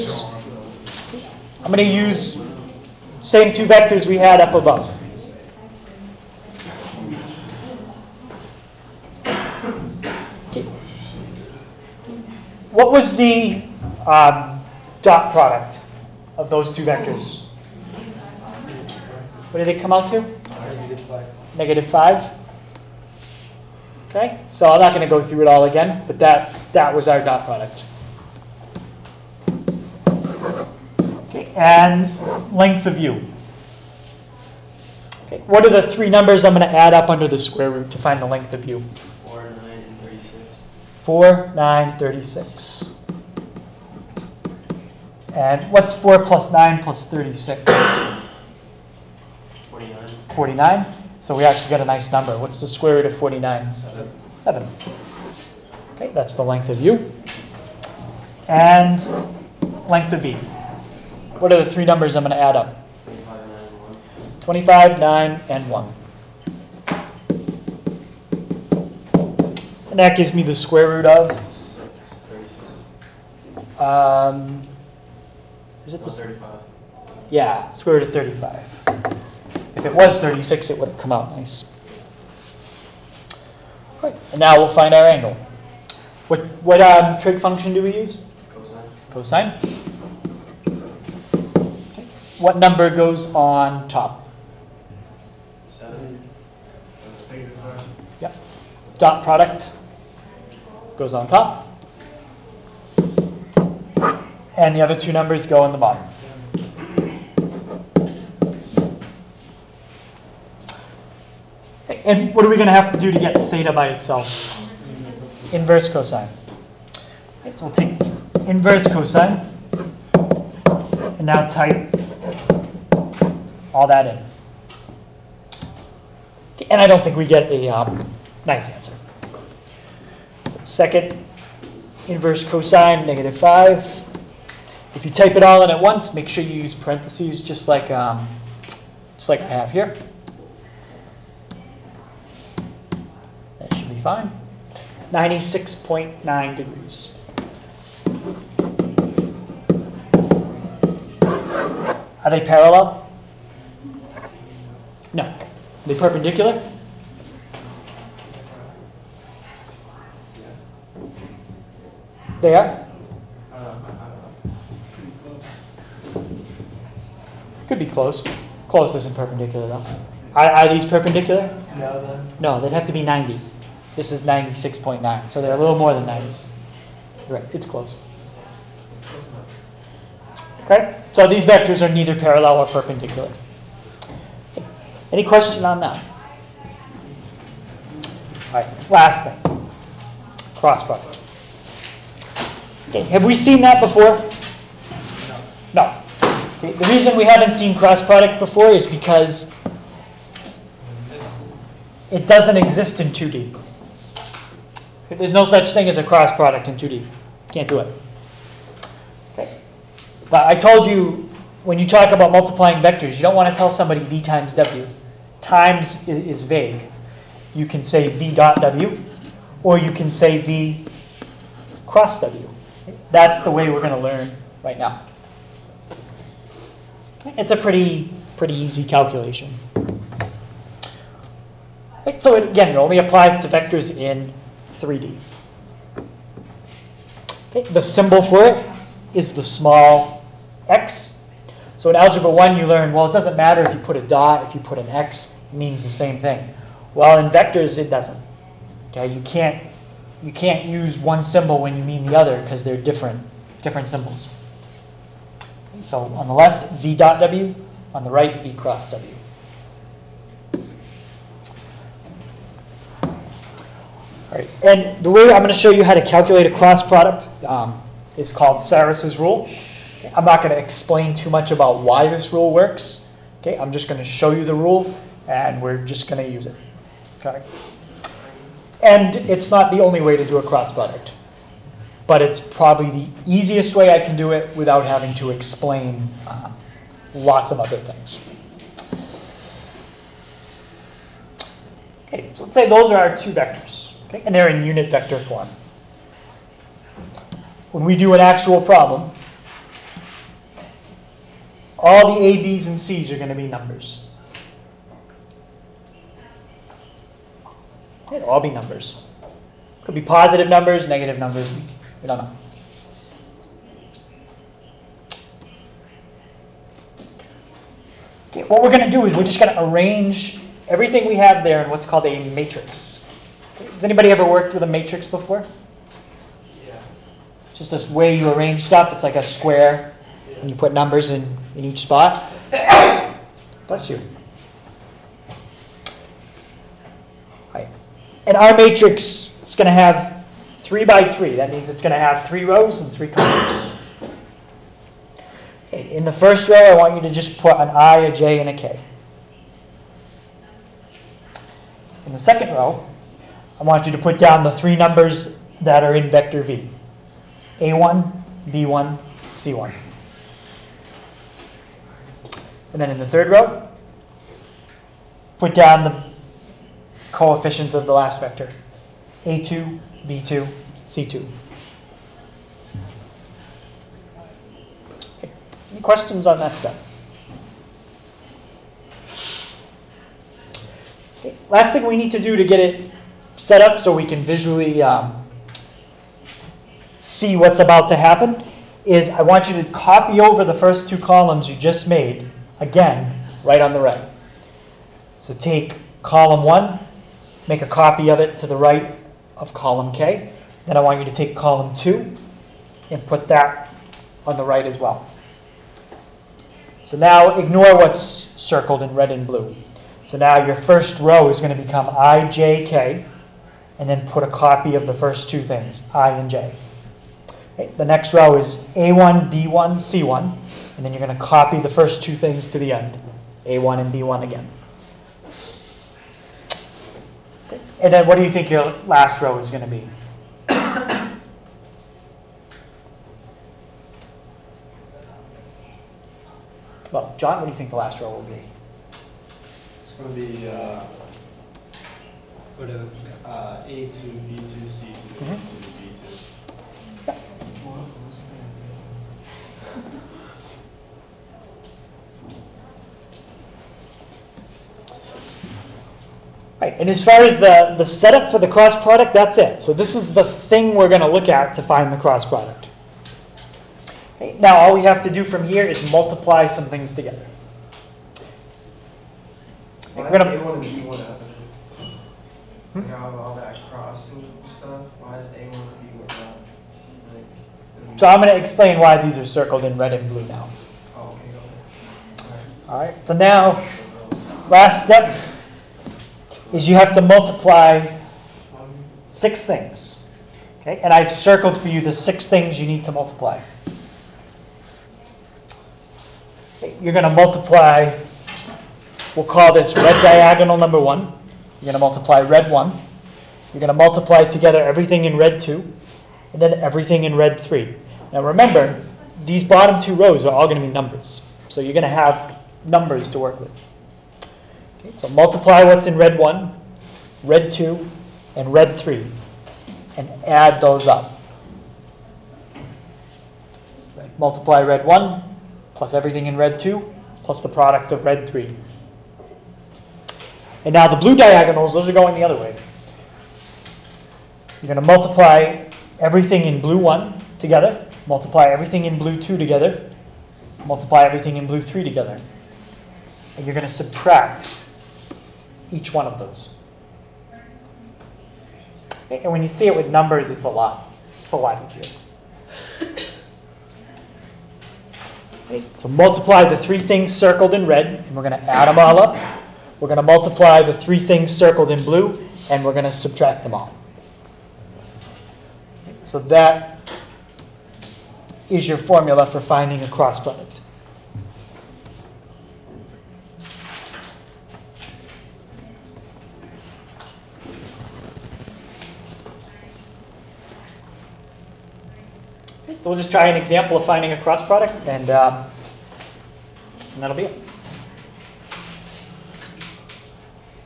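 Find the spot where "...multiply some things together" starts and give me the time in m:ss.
7:45.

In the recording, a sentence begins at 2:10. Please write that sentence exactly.
So second, inverse cosine, negative 5.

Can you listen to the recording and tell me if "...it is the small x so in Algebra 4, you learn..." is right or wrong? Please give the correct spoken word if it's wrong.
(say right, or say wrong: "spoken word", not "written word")
wrong: "1", not "4".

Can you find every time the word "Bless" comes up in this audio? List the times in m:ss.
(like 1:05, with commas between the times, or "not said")
5:33.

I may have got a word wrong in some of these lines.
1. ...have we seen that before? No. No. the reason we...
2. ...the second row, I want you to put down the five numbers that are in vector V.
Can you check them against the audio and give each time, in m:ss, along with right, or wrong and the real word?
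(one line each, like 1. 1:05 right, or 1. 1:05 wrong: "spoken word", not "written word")
1. 3:13 right
2. 5:52 wrong: "three", not "five".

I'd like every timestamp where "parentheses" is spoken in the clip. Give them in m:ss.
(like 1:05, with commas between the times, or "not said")
2:16.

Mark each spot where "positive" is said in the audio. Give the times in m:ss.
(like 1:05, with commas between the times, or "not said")
5:10.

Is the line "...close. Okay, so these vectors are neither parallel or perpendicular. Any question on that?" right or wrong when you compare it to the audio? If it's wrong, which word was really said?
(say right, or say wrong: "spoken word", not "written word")
right.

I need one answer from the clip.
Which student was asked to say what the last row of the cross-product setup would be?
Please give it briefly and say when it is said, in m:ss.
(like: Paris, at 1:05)
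John, at 7:17.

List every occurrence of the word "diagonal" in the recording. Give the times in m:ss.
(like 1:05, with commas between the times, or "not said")
8:20, 8:51.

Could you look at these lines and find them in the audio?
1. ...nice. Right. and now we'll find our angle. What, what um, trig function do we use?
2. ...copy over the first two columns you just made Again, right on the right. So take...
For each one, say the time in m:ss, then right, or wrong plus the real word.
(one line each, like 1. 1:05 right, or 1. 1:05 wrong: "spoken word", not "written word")
1. 1:21 right
2. 6:29 right.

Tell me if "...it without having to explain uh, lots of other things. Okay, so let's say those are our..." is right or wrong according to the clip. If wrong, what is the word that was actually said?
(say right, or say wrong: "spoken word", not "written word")
right.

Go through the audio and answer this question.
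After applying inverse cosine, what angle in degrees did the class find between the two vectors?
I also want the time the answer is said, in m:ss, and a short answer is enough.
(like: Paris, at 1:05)
96.9 degrees, at 2:25.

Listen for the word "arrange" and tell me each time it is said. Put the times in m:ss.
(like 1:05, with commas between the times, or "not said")
5:19, 5:28.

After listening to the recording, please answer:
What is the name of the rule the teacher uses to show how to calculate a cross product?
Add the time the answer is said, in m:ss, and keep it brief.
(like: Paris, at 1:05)
Sarrus's rule, at 4:28.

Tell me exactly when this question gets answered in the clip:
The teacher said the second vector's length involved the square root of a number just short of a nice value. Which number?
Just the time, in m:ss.
1:17.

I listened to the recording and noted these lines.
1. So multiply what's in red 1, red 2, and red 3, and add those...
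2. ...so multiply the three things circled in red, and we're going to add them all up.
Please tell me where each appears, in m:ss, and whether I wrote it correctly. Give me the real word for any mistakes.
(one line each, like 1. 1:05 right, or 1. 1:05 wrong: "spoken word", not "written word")
1. 8:34 right
2. 9:15 right.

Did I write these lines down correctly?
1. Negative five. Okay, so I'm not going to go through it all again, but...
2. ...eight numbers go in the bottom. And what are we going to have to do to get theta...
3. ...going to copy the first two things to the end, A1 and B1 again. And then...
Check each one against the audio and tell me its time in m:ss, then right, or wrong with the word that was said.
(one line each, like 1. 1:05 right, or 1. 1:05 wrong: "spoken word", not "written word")
1. 0:21 right
2. 1:44 wrong: "two", not "eight"
3. 7:01 right.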